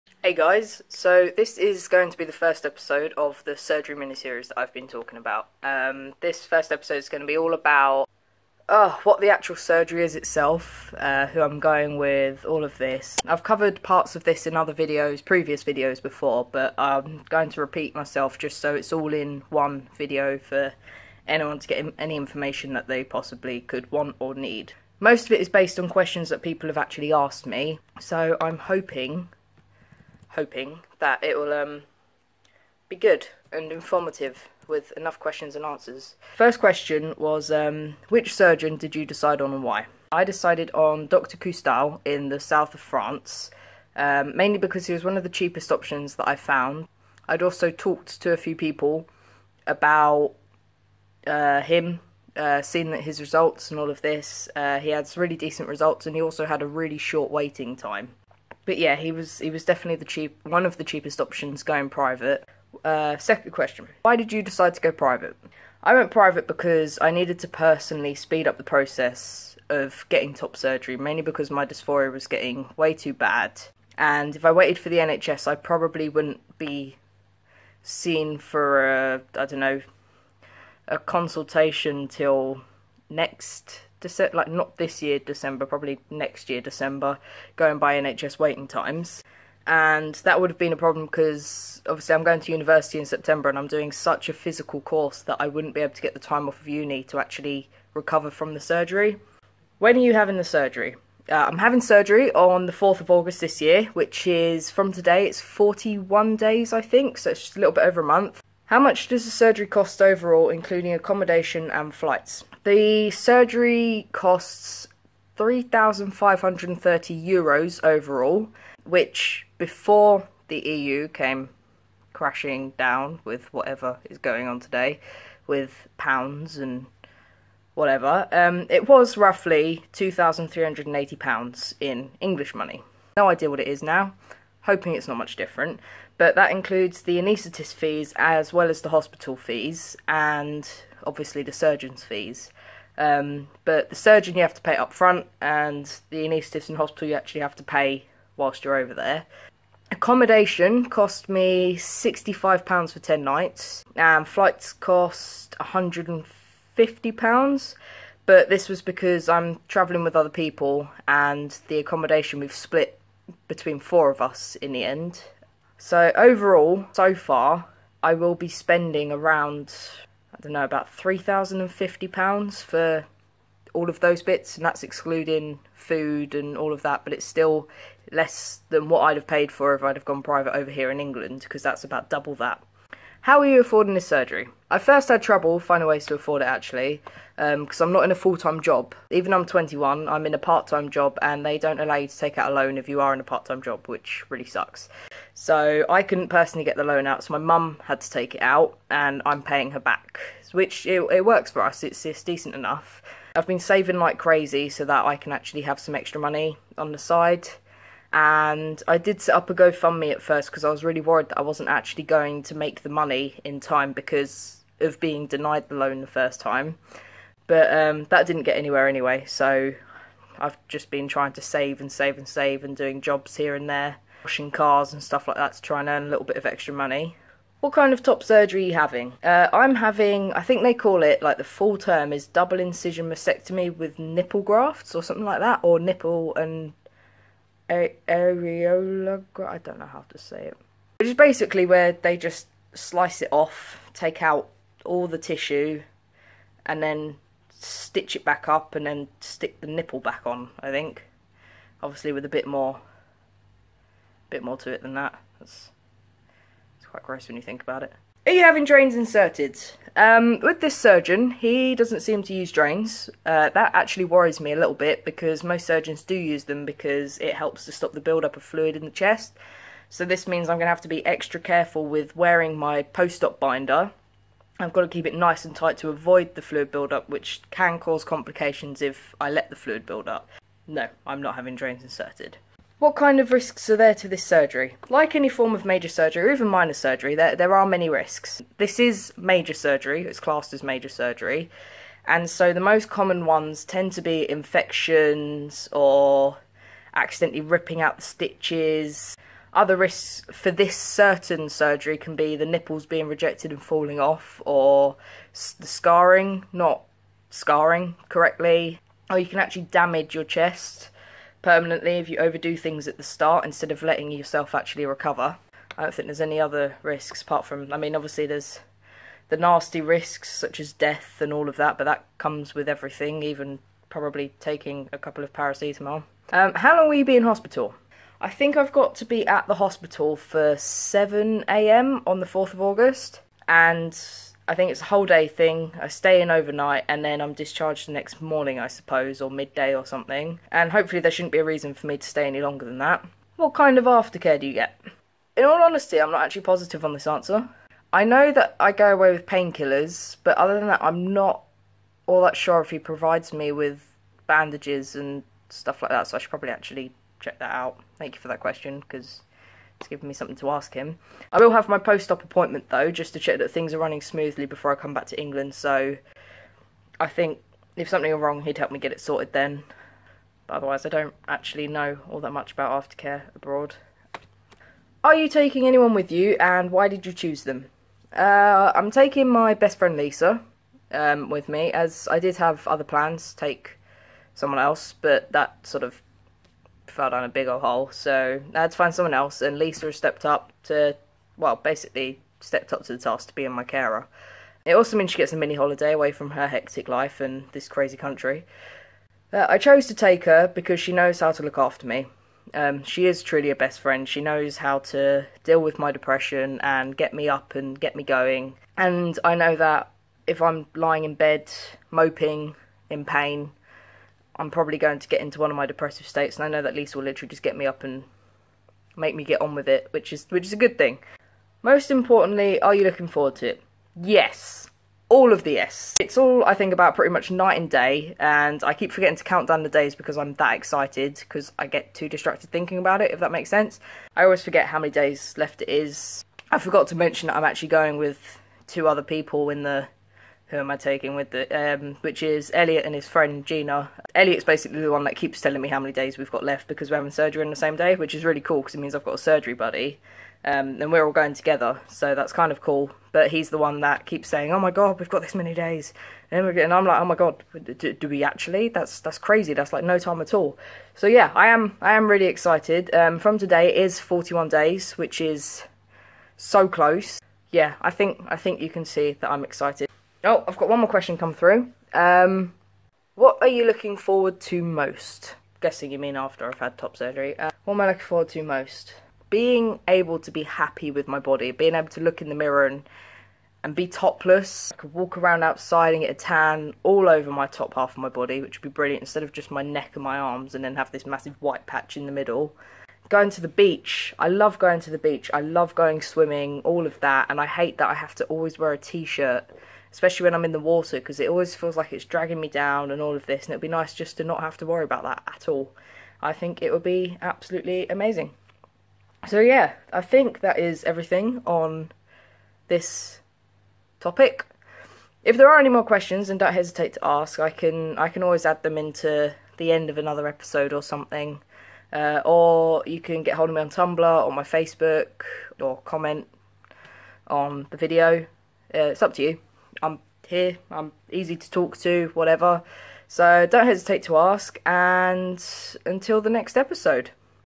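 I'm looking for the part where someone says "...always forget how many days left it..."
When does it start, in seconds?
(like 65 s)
434 s.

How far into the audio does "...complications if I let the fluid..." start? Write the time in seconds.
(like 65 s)
278 s.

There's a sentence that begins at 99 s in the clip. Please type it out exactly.
When are you having the surgery?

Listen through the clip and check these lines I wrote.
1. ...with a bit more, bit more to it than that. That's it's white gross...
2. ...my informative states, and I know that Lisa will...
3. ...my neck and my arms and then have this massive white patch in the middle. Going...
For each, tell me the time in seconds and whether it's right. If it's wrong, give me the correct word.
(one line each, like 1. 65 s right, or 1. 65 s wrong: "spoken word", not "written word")
1. 252 s wrong: "quite", not "white"
2. 415 s wrong: "depressive", not "informative"
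3. 489 s right.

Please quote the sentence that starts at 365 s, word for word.
So I think if something were wrong, he'd help me get it sorted then.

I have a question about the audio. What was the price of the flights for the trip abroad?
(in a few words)
£150.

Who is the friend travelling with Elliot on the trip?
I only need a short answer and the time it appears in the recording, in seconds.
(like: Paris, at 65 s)
Gina, at 443 s.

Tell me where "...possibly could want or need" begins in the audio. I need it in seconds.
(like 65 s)
23 s.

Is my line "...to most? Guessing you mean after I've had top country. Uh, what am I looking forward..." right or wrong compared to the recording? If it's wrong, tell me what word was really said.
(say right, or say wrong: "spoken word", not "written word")
wrong: "surgery", not "country".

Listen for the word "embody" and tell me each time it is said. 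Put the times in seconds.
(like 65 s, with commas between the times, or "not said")
not said.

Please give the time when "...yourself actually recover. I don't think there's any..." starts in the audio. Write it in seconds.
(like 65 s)
314 s.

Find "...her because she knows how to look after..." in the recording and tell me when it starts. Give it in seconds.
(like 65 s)
400 s.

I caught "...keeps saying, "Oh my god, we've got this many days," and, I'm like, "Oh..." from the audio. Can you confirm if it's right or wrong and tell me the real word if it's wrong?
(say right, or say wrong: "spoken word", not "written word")
right.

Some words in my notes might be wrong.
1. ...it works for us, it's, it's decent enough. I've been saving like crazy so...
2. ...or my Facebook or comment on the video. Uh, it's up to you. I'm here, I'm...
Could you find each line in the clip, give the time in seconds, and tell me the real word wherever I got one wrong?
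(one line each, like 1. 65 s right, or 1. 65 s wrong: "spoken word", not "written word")
1. 201 s right
2. 524 s right.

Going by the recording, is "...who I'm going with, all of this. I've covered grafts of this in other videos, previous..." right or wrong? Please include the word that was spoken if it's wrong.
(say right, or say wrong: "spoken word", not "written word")
wrong: "parts", not "grafts".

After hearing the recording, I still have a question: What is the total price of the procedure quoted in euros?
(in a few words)
3,530 euros.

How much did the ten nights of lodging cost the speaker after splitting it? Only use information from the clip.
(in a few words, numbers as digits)
£65.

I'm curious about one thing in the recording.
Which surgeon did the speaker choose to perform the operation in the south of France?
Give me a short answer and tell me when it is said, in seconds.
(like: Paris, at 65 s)
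Dr. Coustal, at 41 s.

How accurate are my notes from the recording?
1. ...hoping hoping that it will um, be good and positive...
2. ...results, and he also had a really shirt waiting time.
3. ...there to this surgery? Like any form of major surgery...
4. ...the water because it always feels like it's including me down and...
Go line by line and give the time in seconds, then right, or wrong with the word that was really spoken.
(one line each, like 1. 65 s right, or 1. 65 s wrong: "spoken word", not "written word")
1. 28 s wrong: "informative", not "positive"
2. 55 s wrong: "short", not "shirt"
3. 283 s right
4. 500 s wrong: "dragging", not "including".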